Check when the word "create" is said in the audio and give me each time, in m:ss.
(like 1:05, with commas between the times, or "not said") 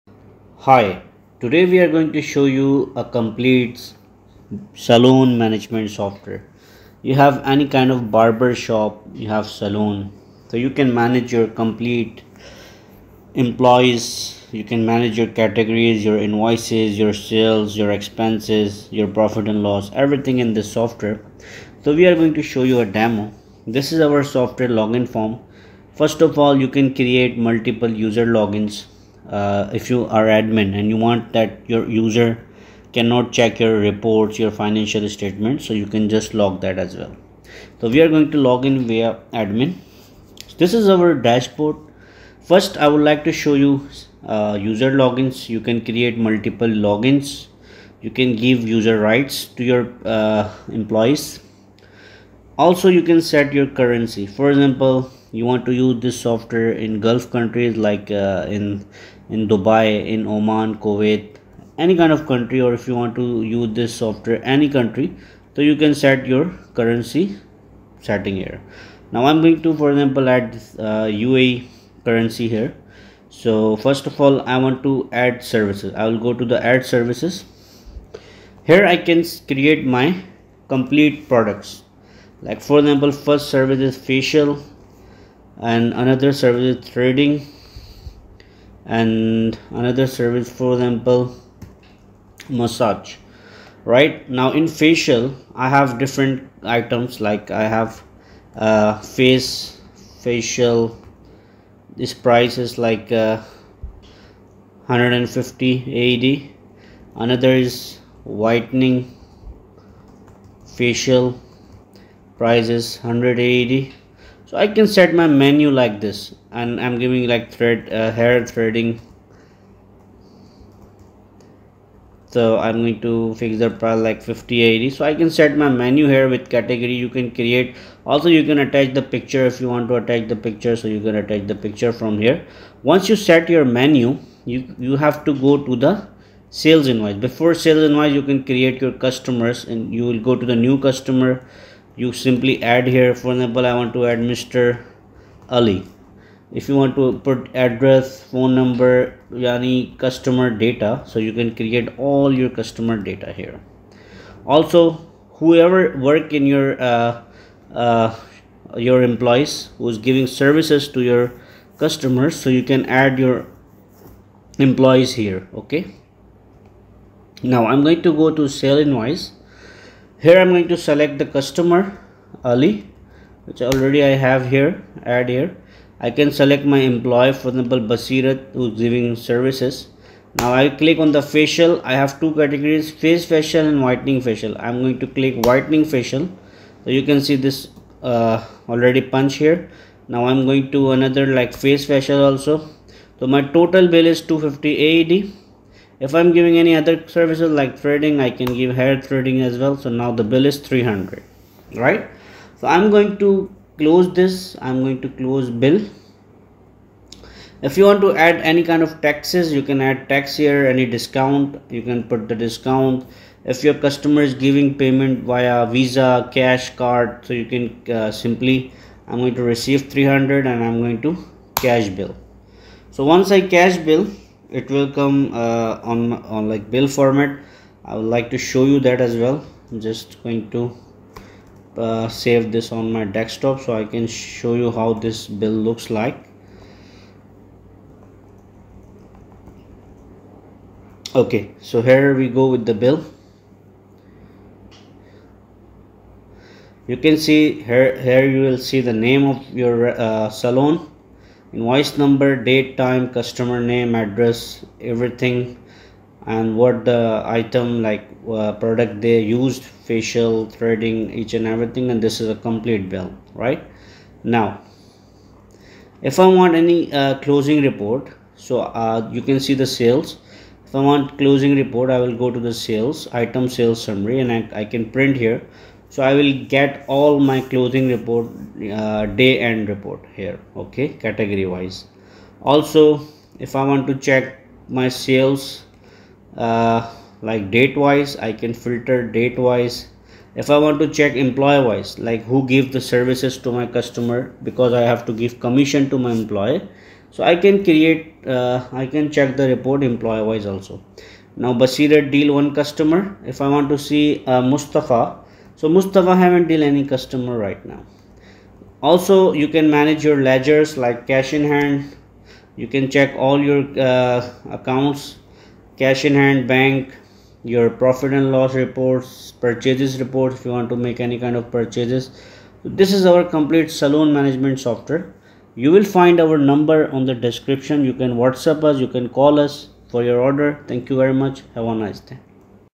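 0:26, 0:45, 1:19, 2:07, 2:18, 2:31, 4:57.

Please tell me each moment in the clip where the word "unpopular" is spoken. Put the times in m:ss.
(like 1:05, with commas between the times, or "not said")
not said.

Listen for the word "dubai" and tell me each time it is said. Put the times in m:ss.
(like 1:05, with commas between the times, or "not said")
0:59.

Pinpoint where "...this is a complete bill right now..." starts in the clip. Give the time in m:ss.
4:22.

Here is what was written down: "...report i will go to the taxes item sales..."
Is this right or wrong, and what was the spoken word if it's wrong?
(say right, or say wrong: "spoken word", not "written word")
wrong: "sales", not "taxes".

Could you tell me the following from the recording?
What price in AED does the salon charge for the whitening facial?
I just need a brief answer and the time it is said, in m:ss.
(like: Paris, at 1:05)
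100, at 1:52.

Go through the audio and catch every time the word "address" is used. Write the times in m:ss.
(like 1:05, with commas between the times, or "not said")
2:27, 4:13.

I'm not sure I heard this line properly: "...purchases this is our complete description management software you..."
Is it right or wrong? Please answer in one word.
wrong.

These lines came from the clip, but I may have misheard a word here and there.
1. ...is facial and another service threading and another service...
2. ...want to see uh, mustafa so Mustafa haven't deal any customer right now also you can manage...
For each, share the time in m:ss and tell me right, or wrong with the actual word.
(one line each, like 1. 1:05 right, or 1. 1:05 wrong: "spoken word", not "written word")
1. 1:23 right
2. 5:03 right.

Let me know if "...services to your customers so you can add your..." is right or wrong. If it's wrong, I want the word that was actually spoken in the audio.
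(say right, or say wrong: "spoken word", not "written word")
right.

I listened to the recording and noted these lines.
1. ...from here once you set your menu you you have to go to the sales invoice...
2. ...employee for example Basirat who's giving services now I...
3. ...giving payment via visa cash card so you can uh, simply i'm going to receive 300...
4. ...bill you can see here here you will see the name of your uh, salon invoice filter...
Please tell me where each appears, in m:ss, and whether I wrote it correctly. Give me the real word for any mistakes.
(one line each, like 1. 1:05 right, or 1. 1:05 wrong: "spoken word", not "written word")
1. 2:11 right
2. 2:56 right
3. 3:34 right
4. 4:02 wrong: "number", not "filter".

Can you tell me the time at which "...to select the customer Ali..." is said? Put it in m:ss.
2:50.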